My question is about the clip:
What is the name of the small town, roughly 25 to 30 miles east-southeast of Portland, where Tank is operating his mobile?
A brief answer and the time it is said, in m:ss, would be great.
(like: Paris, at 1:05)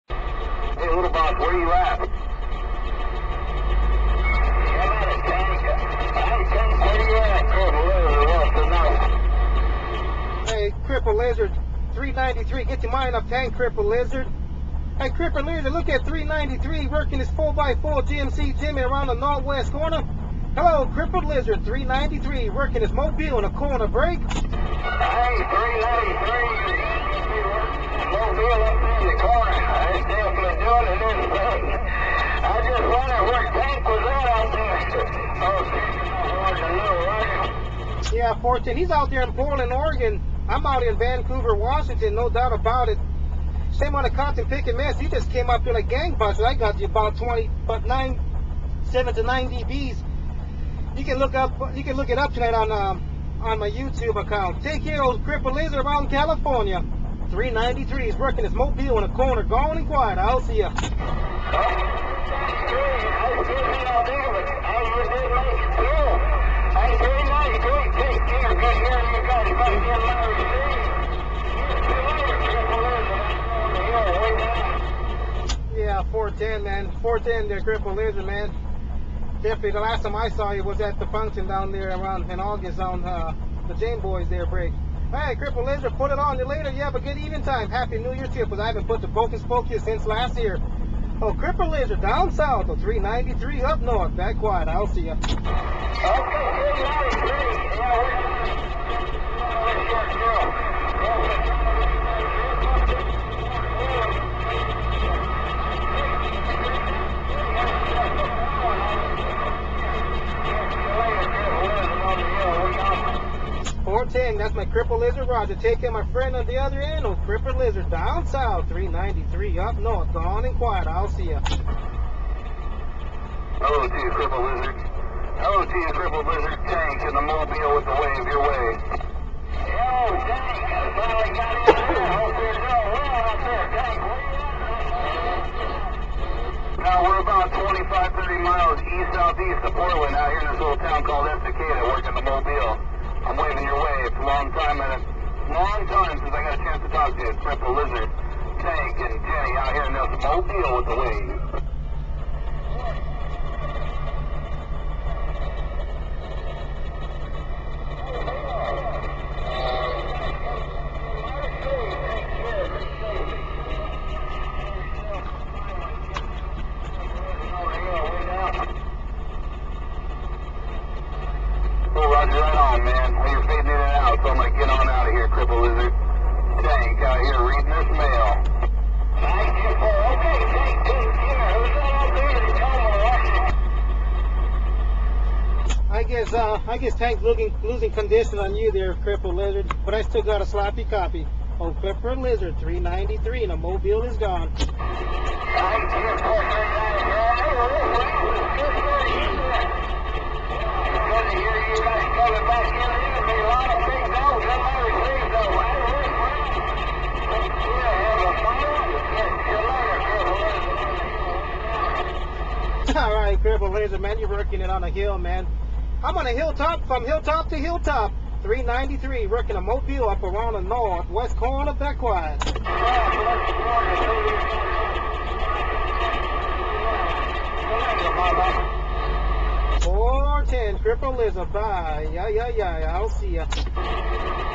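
Estacada, at 2:21.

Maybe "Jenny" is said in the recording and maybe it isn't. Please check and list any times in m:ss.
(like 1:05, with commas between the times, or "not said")
2:29.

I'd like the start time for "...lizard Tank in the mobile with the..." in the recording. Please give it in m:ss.
2:06.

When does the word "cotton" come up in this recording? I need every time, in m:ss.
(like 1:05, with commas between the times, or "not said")
0:44.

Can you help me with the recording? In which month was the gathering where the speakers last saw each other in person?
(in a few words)
August.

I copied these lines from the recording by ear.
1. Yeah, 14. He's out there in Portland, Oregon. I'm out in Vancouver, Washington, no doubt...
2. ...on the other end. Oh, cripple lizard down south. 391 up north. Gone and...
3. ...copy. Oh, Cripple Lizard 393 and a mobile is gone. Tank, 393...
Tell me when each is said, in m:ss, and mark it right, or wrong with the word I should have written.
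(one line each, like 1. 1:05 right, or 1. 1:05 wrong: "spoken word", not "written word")
1. 0:38 right
2. 1:56 wrong: "393", not "391"
3. 3:10 right.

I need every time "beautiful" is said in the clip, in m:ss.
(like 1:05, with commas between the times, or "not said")
2:59.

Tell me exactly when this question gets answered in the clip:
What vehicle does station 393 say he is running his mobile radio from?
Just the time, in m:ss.
0:17.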